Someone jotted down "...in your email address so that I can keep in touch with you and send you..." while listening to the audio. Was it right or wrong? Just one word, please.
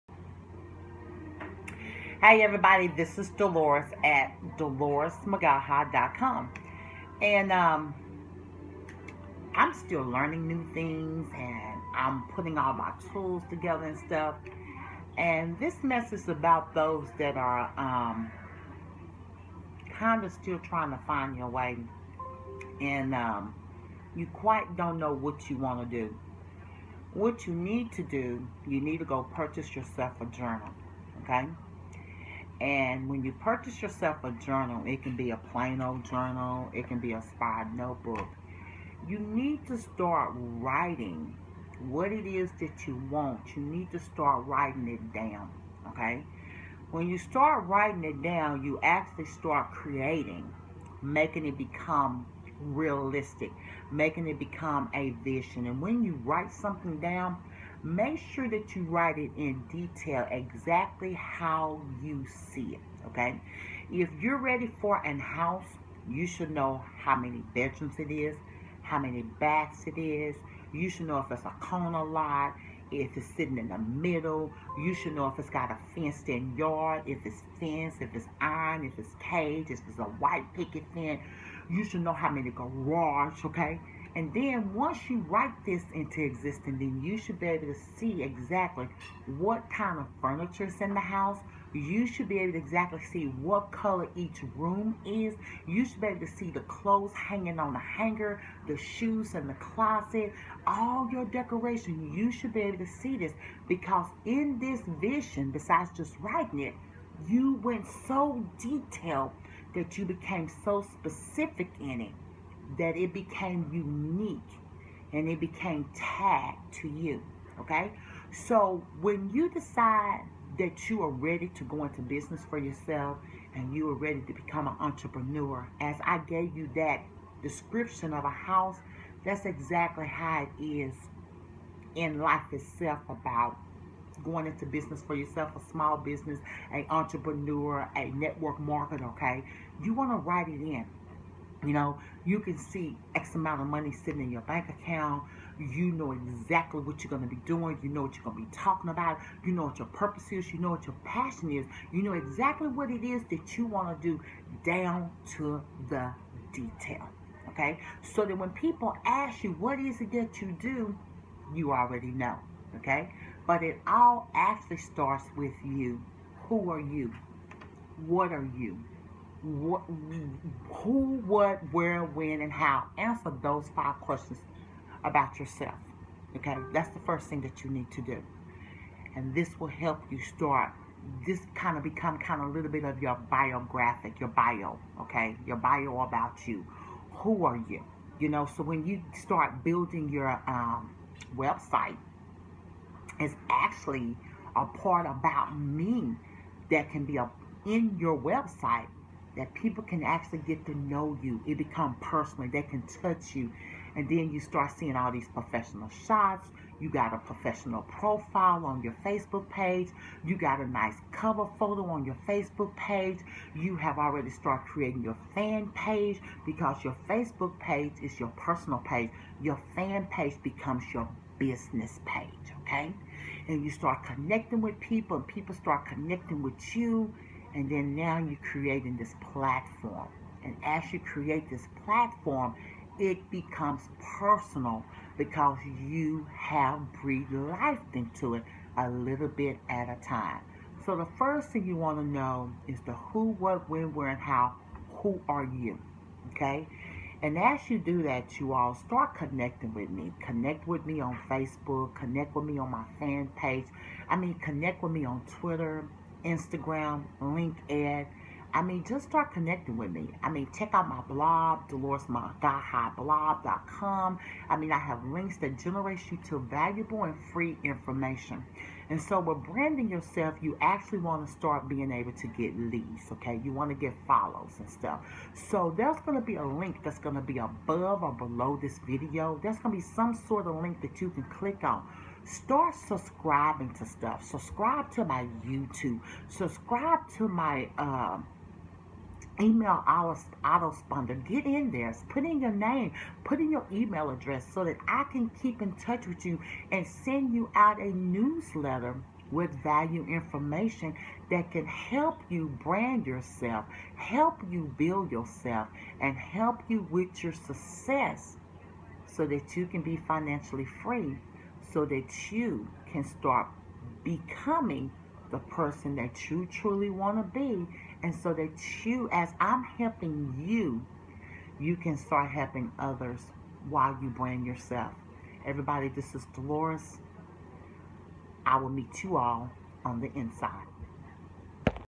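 right.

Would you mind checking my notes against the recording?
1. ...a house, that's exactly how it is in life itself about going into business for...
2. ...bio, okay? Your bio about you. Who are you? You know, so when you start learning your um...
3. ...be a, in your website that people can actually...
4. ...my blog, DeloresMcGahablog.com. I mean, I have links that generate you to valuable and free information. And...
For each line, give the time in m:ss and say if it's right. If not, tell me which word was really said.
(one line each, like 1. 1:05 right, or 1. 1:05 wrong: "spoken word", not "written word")
1. 2:08 right
2. 3:04 wrong: "building", not "learning"
3. 3:17 right
4. 4:20 right.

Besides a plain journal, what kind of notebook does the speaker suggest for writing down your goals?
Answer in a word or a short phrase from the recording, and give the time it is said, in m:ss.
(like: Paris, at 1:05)
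A spy notebook, at 0:37.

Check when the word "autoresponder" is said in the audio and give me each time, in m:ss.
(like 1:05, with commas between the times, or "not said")
4:49.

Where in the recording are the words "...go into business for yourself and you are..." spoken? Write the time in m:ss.
2:01.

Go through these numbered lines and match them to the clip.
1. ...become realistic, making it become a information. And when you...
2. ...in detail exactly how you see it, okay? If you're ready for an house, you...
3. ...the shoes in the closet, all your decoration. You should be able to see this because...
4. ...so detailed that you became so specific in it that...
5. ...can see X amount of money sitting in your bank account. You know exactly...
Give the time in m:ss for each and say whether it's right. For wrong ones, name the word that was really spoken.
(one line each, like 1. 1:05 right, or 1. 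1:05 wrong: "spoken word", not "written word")
1. 0:51 wrong: "vision", not "information"
2. 0:59 right
3. 1:38 right
4. 1:48 right
5. 2:22 right.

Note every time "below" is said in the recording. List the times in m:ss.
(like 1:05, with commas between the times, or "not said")
4:38.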